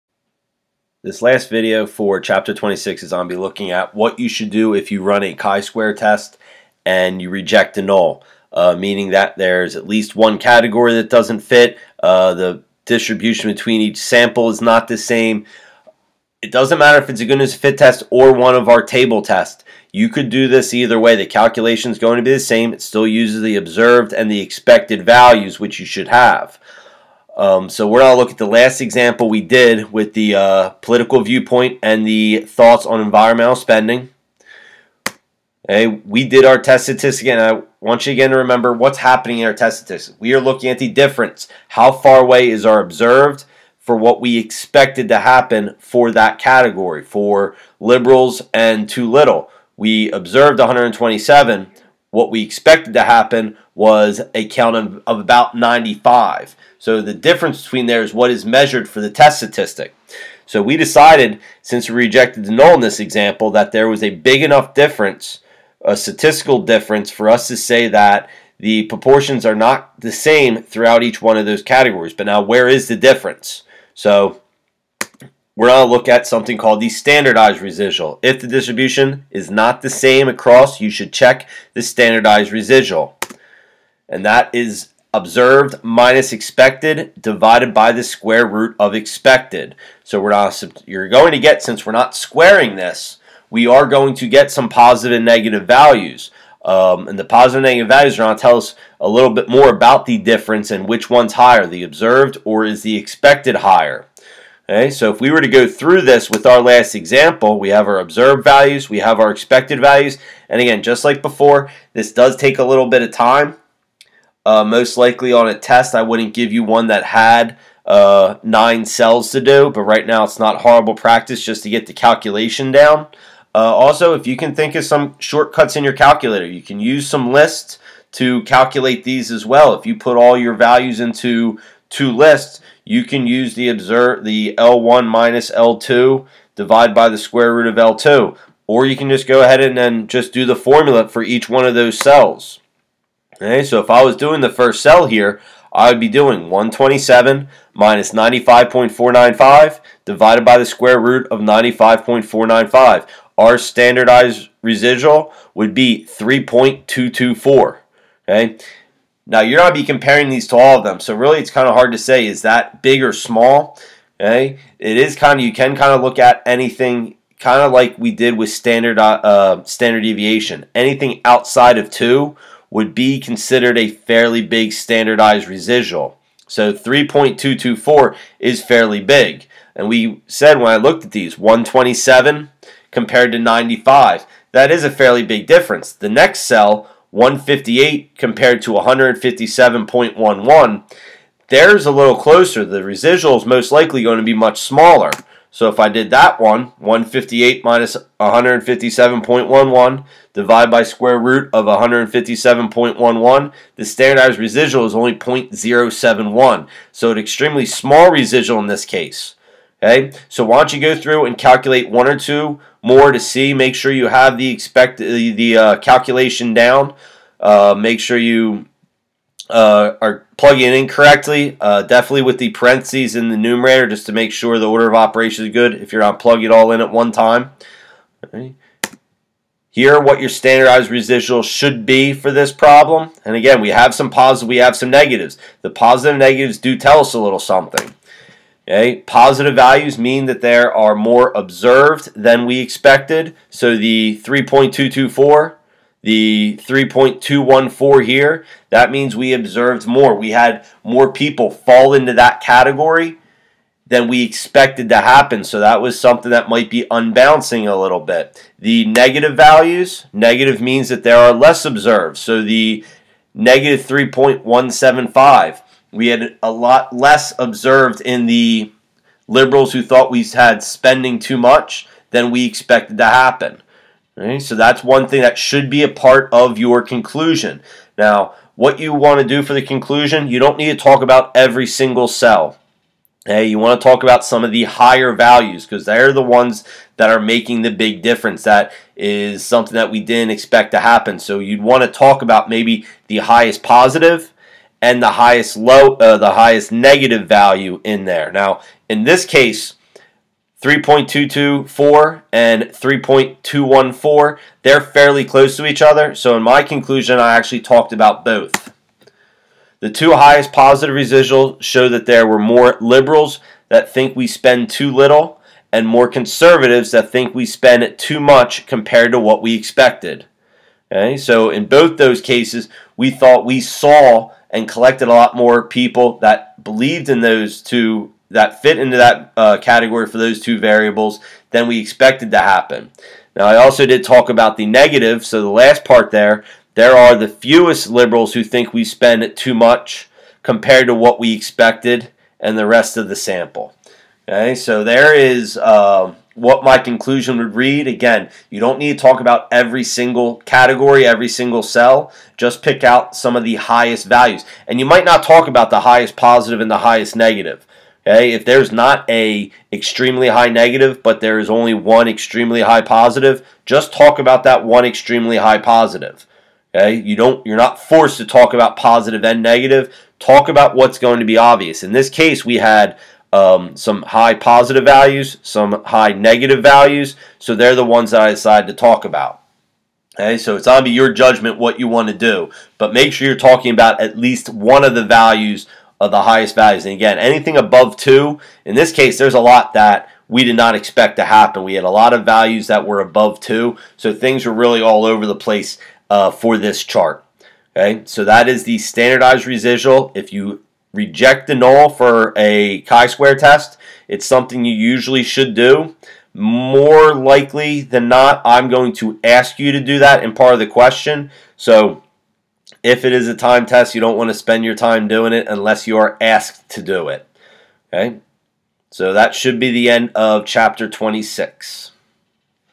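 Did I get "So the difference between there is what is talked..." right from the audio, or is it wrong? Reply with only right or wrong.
wrong.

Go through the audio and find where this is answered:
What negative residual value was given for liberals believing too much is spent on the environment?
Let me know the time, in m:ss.
4:23.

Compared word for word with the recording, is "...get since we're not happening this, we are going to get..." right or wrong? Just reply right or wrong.
wrong.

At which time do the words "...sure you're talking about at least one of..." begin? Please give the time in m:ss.
6:23.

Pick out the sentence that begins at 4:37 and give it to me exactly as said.
Now, what you want to do for the conclusion, you don't need to talk about every single cell.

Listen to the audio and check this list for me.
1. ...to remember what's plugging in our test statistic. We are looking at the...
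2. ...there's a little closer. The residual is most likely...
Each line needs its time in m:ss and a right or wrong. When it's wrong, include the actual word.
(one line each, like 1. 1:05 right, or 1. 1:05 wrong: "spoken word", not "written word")
1. 0:38 wrong: "happening", not "plugging"
2. 3:11 right.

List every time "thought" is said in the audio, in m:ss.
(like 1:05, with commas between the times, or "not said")
0:32, 4:29, 5:23.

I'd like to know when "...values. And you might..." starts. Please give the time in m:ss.
5:54.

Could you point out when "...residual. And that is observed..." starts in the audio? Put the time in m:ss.
1:22.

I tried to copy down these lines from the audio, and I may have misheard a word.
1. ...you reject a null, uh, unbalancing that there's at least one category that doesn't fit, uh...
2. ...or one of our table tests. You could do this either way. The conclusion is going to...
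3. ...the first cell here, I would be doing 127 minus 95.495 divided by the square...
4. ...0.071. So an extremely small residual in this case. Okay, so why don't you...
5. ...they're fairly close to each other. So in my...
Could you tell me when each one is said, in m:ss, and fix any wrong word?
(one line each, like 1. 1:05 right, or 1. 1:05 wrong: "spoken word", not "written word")
1. 0:07 wrong: "meaning", not "unbalancing"
2. 0:18 wrong: "calculation", not "conclusion"
3. 2:24 right
4. 3:25 right
5. 5:04 right.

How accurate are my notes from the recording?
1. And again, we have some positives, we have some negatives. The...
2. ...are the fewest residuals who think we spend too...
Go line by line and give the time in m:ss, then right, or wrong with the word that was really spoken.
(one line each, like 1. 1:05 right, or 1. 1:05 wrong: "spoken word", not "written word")
1. 3:53 right
2. 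5:36 wrong: "liberals", not "residuals".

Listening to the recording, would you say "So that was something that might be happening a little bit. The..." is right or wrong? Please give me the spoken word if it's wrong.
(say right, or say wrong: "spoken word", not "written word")
wrong: "unbalancing", not "happening".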